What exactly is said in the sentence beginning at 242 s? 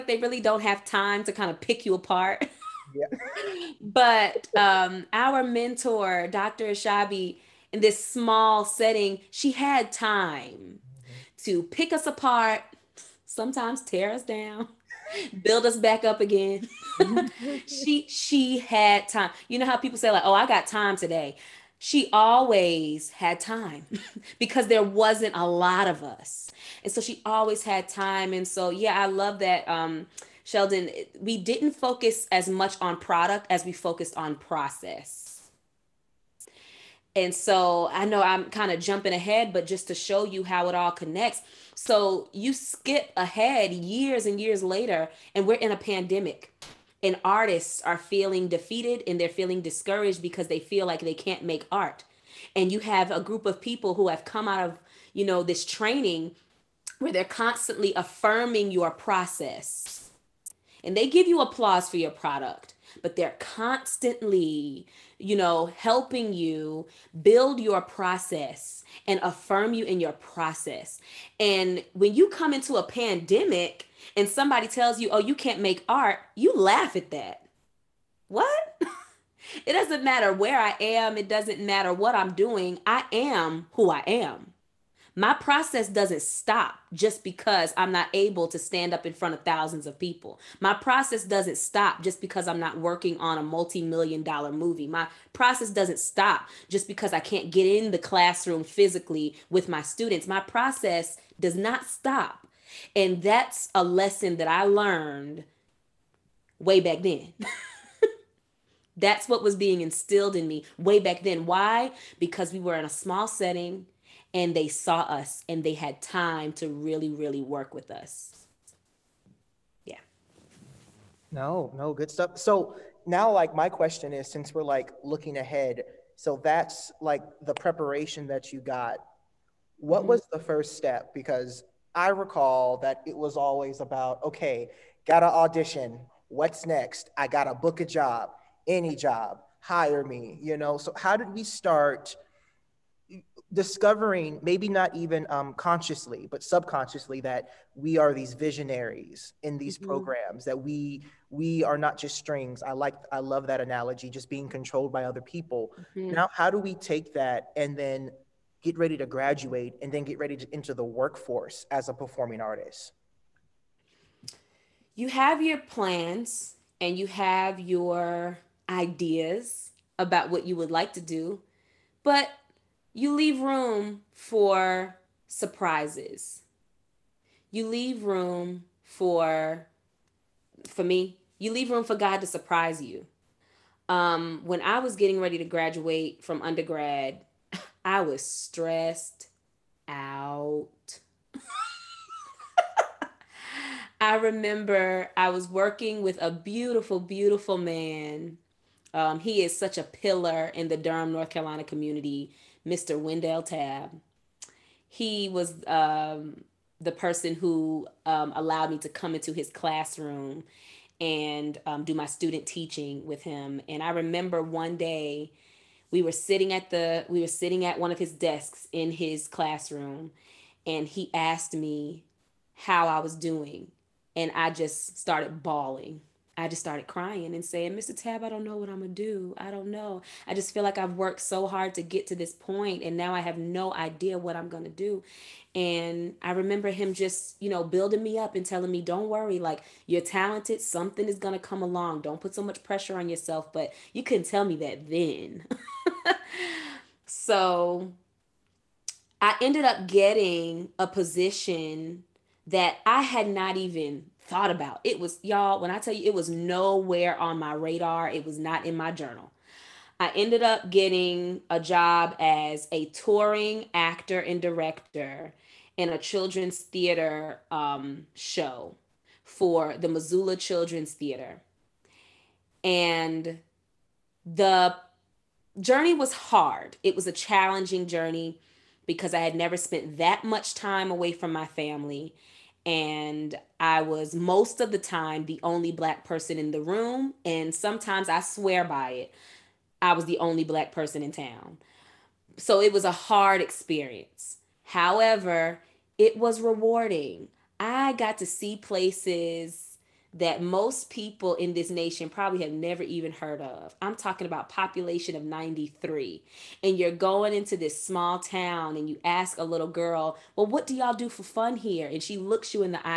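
Don't put so much pressure on yourself.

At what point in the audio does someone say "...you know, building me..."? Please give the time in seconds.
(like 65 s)
237 s.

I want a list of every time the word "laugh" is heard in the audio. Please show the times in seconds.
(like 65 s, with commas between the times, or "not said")
76 s.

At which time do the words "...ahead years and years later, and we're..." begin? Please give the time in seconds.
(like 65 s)
43 s.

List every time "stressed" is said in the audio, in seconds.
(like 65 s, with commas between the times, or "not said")
188 s.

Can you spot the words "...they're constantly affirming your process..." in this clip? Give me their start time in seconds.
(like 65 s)
57 s.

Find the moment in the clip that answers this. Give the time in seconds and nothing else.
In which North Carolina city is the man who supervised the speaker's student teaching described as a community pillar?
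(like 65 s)
200 s.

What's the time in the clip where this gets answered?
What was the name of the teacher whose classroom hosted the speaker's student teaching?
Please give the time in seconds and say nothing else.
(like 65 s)
202 s.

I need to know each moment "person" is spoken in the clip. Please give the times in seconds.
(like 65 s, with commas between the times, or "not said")
206 s, 286 s, 290 s.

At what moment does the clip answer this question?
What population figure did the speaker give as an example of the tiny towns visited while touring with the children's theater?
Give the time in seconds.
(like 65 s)
305 s.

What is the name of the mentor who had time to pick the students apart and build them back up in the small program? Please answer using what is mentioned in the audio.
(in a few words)
Dr. Shabi.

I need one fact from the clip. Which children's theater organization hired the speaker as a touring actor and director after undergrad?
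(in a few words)
Missoula Children's Theater.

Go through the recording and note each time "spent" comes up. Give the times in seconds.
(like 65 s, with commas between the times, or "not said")
279 s.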